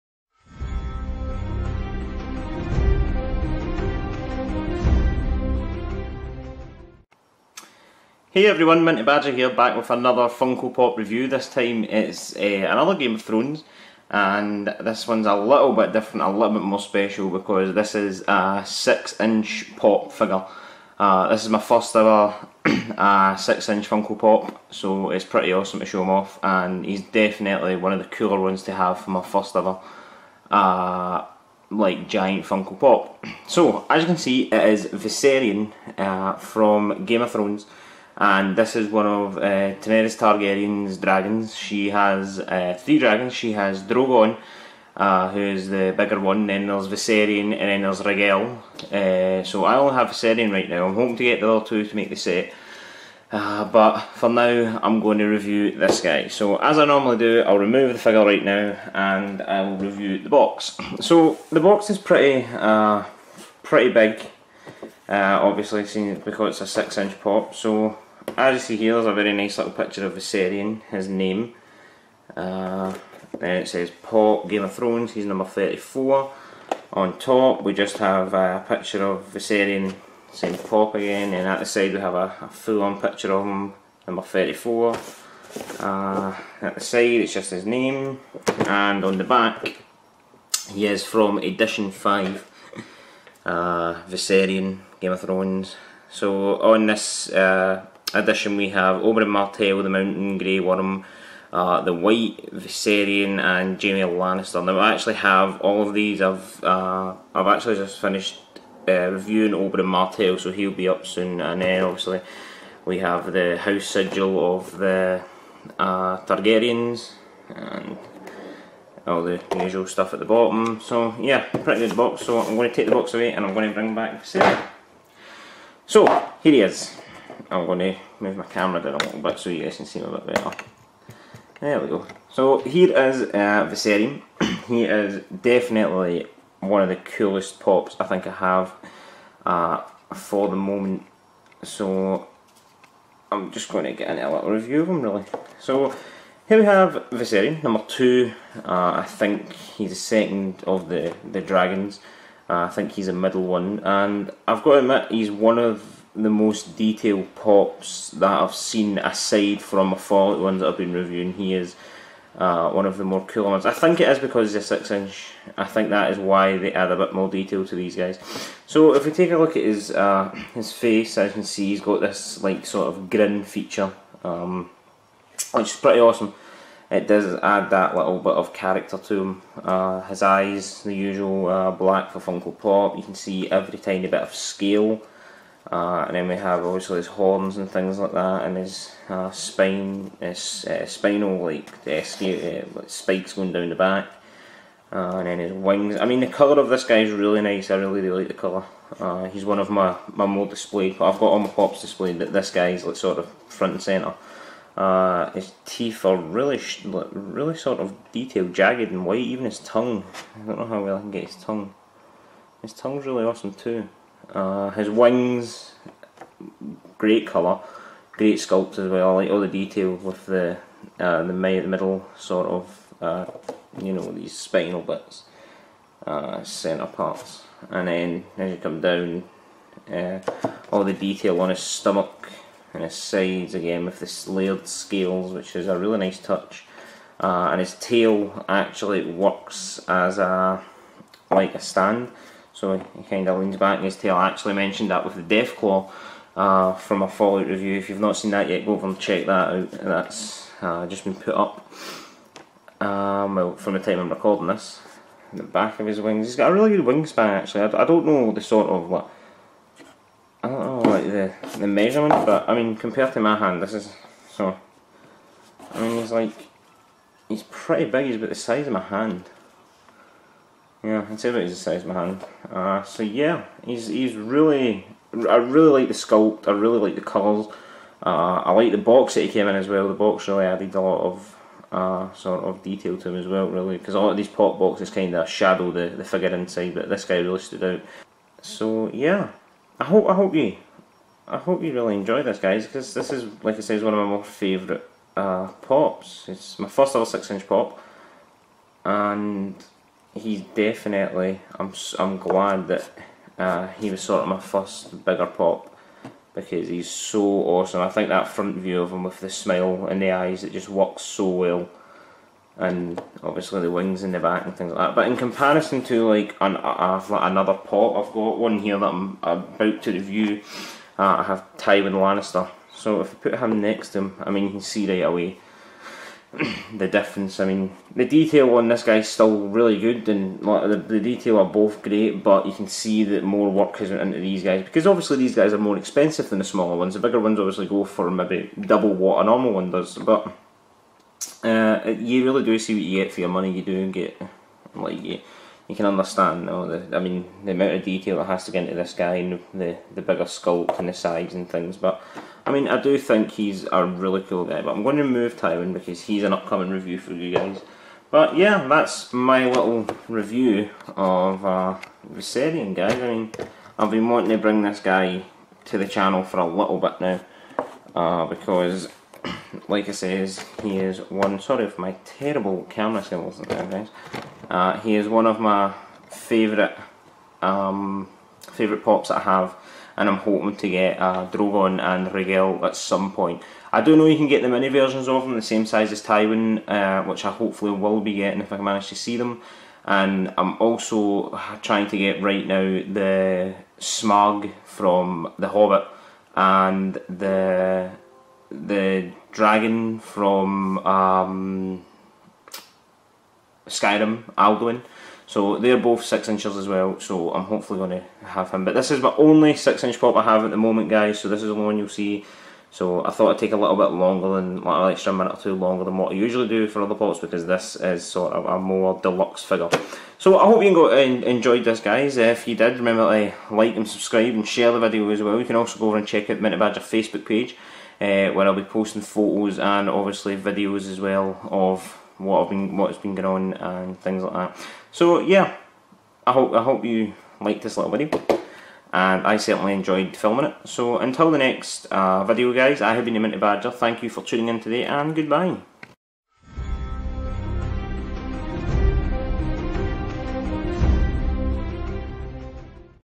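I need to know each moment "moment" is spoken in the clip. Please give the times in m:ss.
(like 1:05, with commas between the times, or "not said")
2:20, 6:50.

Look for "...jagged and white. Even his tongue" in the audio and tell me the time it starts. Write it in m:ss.
3:28.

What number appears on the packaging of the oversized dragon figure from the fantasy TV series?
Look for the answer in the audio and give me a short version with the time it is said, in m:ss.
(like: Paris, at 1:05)
34, at 1:15.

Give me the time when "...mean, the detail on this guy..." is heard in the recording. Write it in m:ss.
5:27.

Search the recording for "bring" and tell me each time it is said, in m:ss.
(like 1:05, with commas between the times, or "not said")
2:03, 6:04.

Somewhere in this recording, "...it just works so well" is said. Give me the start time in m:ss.
5:10.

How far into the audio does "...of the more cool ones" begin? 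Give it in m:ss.
2:42.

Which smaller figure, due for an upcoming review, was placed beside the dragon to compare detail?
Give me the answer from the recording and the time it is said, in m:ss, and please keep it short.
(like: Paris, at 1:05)
Tywin Lannister, at 5:21.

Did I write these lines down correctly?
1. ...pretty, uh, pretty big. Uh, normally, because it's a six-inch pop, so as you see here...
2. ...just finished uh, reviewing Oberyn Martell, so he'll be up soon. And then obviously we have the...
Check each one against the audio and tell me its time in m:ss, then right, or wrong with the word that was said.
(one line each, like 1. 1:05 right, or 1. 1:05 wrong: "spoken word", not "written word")
1. 1:01 wrong: "obviously", not "normally"
2. 1:47 right.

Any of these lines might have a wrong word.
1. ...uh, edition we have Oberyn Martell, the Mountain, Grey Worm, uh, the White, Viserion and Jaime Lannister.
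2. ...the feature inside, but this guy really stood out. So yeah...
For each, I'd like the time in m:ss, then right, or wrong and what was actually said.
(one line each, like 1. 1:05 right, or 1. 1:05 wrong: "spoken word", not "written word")
1. 1:37 right
2. 4:45 wrong: "figure", not "feature".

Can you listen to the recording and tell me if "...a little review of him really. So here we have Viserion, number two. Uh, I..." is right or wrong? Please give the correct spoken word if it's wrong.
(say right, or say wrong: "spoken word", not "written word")
right.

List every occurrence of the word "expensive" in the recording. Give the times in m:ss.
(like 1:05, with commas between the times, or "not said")
5:35.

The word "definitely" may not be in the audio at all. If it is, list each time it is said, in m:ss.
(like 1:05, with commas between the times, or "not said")
0:27, 2:15, 5:00.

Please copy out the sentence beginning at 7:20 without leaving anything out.
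So until the next uh, video, guys, I have been the Minty Badger.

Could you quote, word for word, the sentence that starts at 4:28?
He's about the size of my hand.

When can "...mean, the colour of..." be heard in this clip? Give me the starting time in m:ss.
3:16.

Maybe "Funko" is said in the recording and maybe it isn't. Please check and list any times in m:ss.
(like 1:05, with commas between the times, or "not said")
0:10, 0:23, 0:32, 3:02.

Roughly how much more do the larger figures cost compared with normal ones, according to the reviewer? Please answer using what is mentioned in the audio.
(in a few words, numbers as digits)
Double.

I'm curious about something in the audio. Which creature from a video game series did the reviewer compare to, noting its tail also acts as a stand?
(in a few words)
Deathclaw.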